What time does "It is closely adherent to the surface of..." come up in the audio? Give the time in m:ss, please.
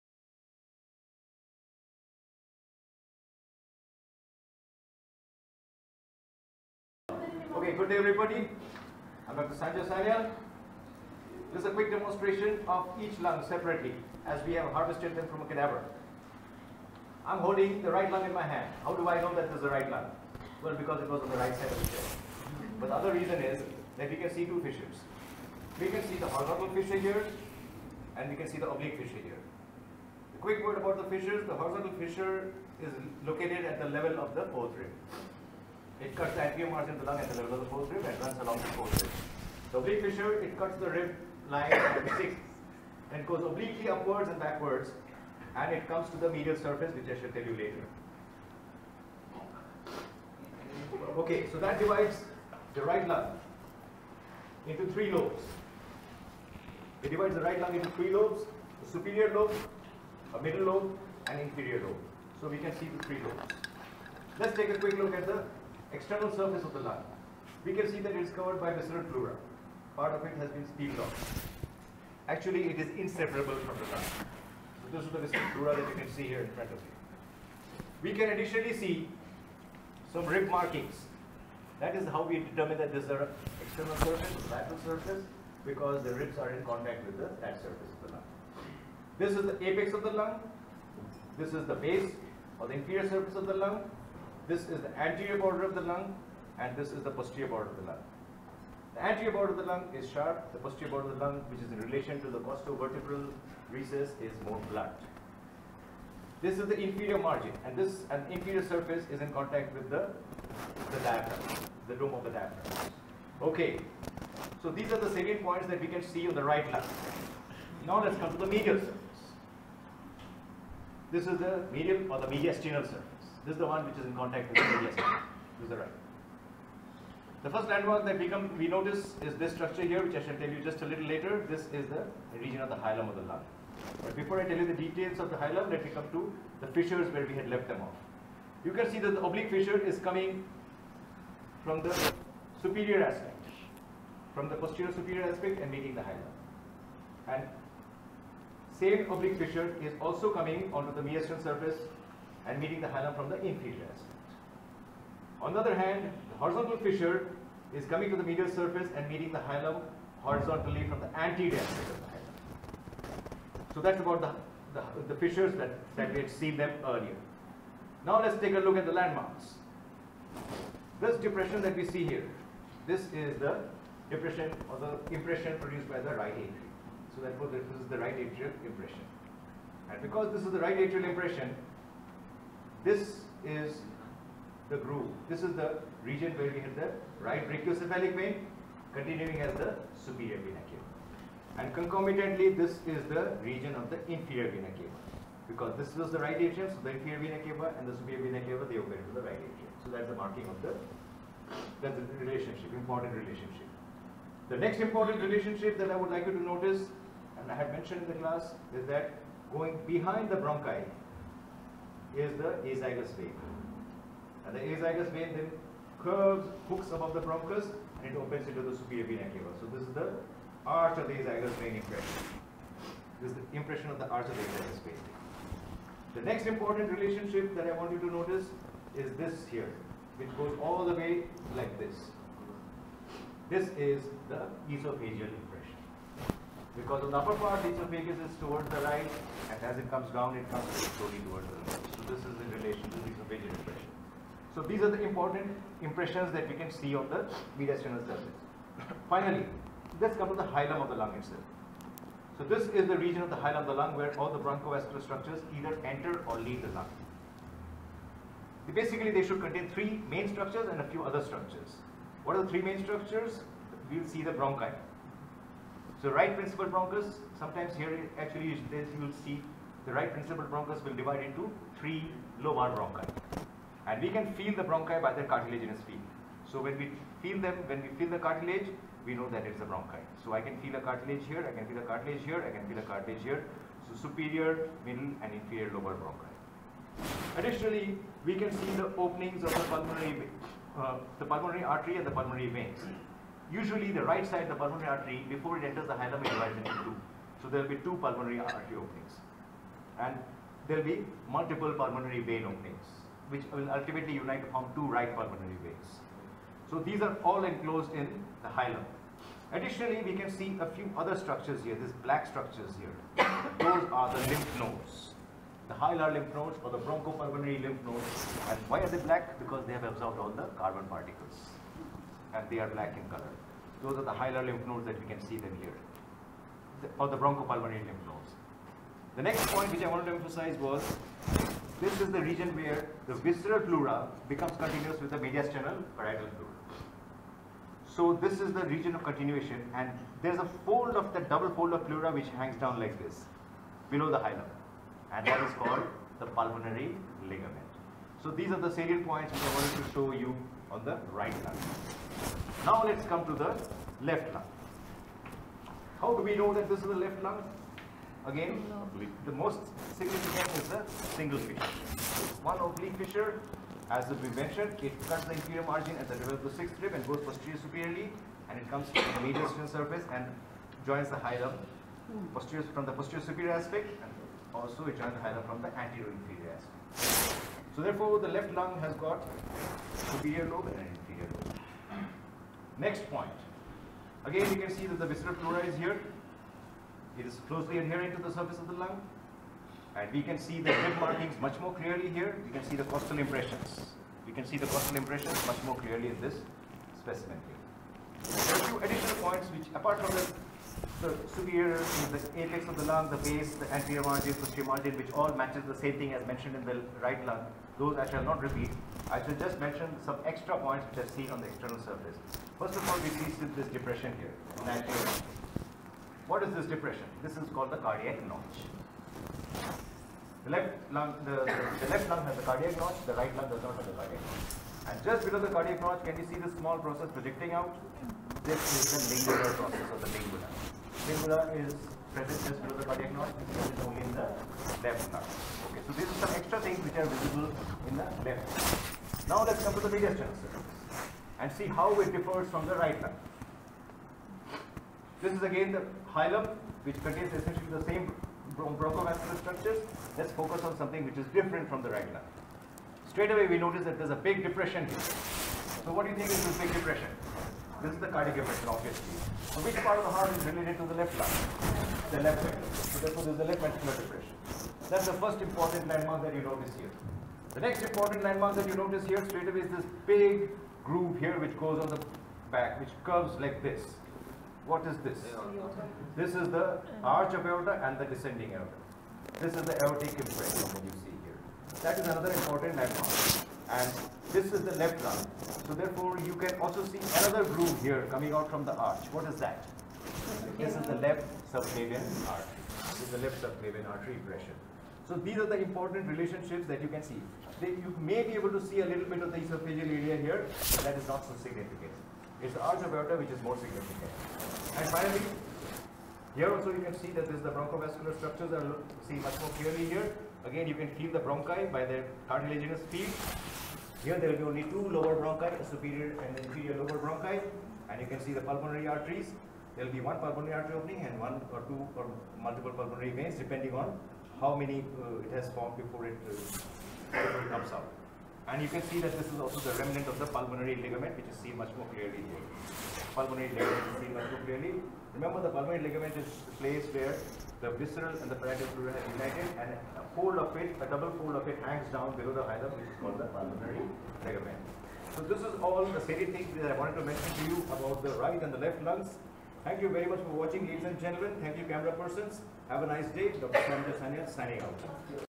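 6:27.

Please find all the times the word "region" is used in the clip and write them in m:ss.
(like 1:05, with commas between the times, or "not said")
2:12, 3:06, 3:13, 4:12, 5:32, 5:38.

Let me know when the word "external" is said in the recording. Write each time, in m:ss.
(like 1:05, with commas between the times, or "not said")
1:05, 1:23, 6:51.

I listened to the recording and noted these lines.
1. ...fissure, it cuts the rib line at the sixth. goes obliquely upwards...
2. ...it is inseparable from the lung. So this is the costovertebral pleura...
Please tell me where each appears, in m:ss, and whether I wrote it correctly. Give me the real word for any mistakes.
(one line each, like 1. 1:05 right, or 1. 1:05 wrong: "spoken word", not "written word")
1. 0:40 right
2. 1:12 wrong: "visceral", not "costovertebral".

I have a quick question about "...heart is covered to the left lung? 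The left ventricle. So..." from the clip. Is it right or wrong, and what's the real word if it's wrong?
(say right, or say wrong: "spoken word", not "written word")
wrong: "related", not "covered".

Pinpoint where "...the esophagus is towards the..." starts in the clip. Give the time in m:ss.
3:57.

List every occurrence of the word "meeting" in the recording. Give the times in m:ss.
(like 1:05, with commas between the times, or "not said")
2:25, 2:32, 2:39.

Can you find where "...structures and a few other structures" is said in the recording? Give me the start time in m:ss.
4:20.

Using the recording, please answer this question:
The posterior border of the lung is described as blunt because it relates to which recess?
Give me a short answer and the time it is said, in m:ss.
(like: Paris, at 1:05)
Costovertebral recess, at 1:42.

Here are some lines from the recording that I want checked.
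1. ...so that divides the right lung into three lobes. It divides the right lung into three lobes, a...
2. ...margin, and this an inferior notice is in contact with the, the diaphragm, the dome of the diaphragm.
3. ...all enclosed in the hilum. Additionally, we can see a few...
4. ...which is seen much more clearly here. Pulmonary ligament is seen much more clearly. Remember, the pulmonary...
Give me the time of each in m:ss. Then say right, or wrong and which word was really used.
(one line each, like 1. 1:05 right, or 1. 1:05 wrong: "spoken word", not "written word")
1. 0:51 right
2. 1:47 wrong: "surface", not "notice"
3. 5:07 right
4. 8:51 right.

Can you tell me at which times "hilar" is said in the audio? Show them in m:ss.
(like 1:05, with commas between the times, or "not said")
5:15, 5:24.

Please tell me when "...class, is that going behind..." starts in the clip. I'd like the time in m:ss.
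3:28.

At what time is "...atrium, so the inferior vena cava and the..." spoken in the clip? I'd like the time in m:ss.
3:16.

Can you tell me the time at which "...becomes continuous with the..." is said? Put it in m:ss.
5:34.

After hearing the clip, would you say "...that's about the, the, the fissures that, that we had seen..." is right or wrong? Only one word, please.
right.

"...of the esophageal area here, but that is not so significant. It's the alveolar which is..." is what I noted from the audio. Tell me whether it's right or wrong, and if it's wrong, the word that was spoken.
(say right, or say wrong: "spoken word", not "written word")
right.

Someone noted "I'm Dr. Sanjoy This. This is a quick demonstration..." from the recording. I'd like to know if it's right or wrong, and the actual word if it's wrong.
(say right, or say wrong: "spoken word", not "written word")
wrong: "Sanyal", not "This".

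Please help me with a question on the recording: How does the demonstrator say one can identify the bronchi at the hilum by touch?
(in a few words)
Cartilaginous feel.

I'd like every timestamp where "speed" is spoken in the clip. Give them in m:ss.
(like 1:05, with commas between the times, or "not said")
8:32.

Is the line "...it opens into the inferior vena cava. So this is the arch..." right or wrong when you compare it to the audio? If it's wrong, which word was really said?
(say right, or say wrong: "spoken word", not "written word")
wrong: "superior", not "inferior".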